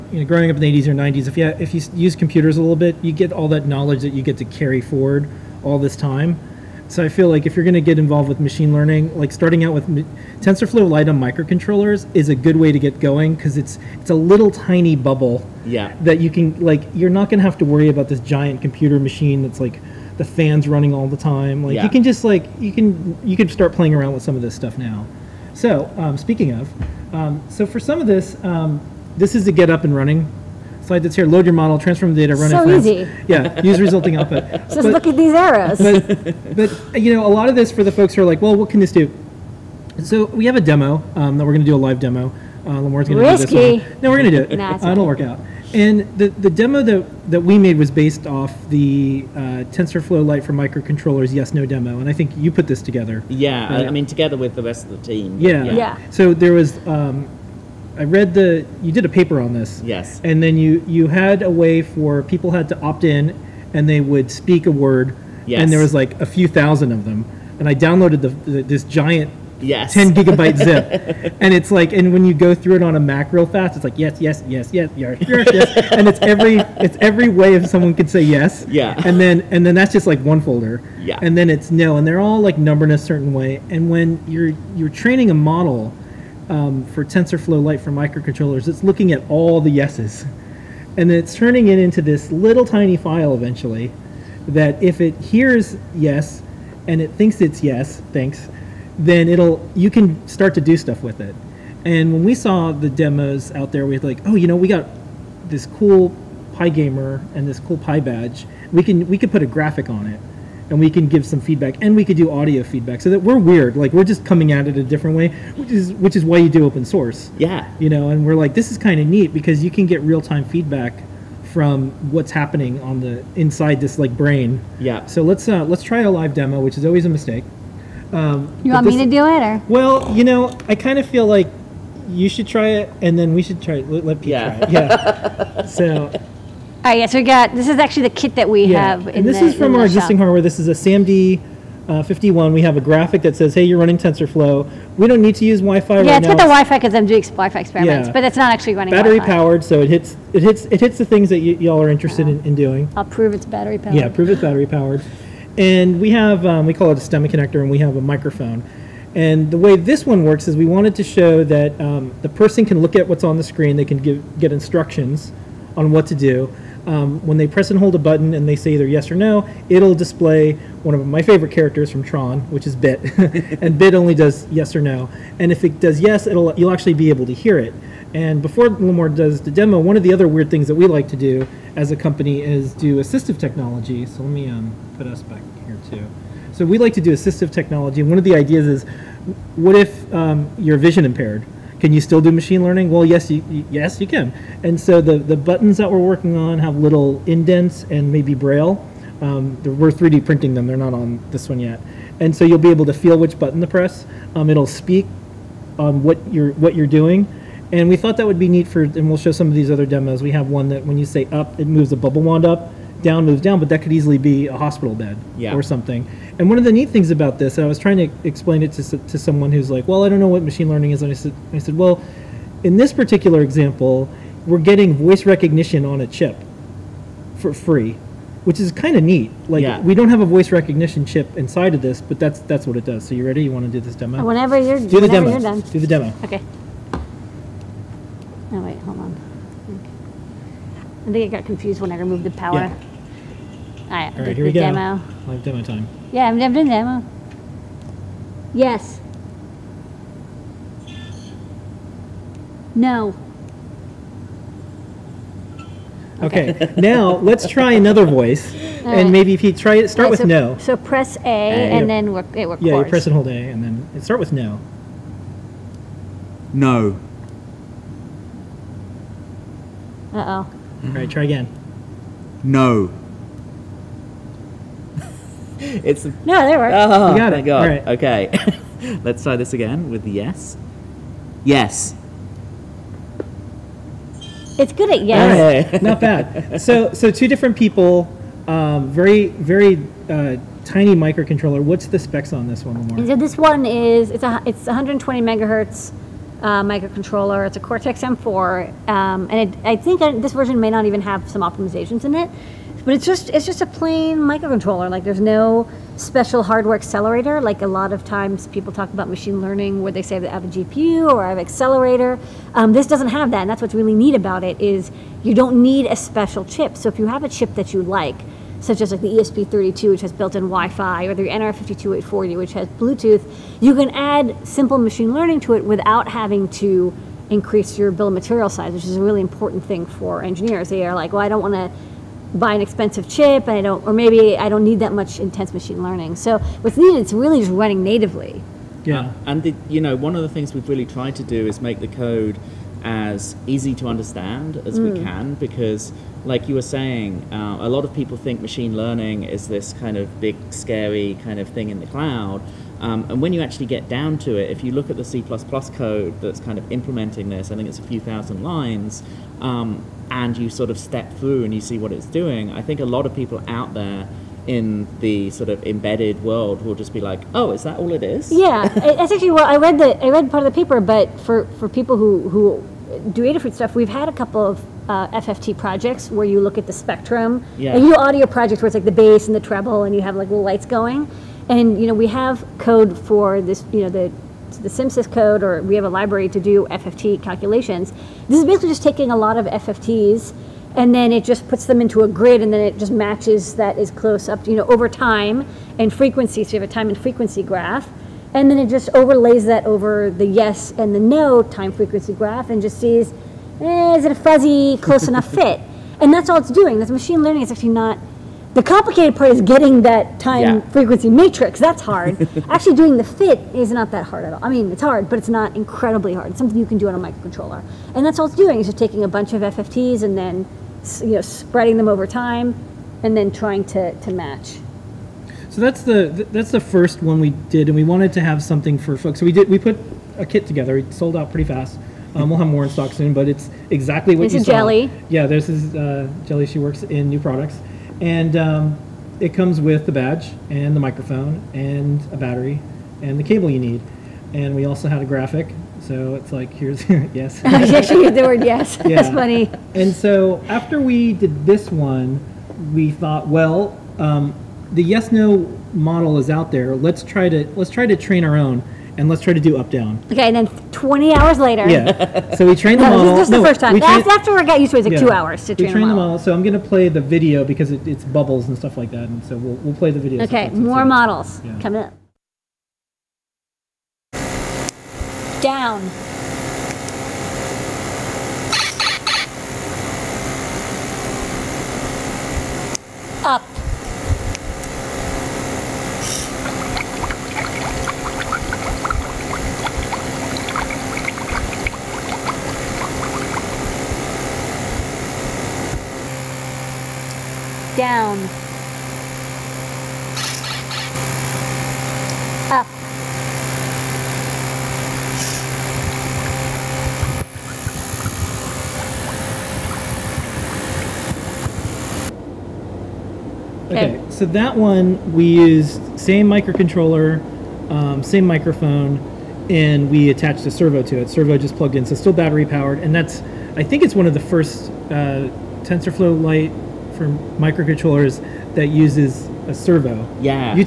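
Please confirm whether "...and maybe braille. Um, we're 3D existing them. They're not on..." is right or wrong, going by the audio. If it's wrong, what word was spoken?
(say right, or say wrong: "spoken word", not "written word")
wrong: "printing", not "existing".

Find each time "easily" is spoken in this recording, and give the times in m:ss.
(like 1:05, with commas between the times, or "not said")
3:33.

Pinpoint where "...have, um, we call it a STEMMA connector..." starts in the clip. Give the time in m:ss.
2:36.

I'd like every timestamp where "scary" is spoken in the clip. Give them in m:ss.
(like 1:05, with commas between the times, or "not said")
5:50.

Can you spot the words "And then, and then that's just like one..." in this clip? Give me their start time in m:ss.
1:19.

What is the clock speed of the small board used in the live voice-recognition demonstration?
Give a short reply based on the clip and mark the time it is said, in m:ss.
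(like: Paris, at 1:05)
120 megahertz, at 4:54.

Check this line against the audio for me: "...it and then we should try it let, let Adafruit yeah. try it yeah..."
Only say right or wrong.
wrong.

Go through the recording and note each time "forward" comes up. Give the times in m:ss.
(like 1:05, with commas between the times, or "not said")
0:04.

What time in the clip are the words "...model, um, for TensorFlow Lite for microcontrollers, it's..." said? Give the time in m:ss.
1:25.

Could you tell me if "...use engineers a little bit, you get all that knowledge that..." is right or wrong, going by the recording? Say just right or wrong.
wrong.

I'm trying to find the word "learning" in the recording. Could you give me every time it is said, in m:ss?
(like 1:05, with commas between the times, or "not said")
0:08, 3:12, 3:40, 5:09, 5:25, 5:35, 5:48, 6:47.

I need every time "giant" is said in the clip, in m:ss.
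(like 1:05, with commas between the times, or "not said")
0:18, 1:08.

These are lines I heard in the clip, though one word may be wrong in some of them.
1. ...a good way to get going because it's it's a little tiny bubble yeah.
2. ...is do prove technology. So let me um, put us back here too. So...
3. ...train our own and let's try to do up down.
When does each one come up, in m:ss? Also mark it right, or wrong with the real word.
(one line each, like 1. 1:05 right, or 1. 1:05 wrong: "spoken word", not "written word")
1. 0:12 right
2. 3:02 wrong: "assistive", not "prove"
3. 7:37 right.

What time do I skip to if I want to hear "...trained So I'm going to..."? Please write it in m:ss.
7:45.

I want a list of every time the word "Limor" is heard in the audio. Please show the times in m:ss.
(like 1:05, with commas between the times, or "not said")
0:42, 2:58, 4:52.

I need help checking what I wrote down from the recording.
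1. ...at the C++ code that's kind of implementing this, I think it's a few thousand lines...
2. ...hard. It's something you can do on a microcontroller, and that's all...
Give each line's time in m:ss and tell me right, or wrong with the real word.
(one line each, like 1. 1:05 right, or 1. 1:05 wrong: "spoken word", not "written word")
1. 5:54 right
2. 6:56 right.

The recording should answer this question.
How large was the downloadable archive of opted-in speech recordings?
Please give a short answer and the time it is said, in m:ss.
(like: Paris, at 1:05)
10 gigabytes, at 1:09.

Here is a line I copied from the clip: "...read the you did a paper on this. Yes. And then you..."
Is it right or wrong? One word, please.
right.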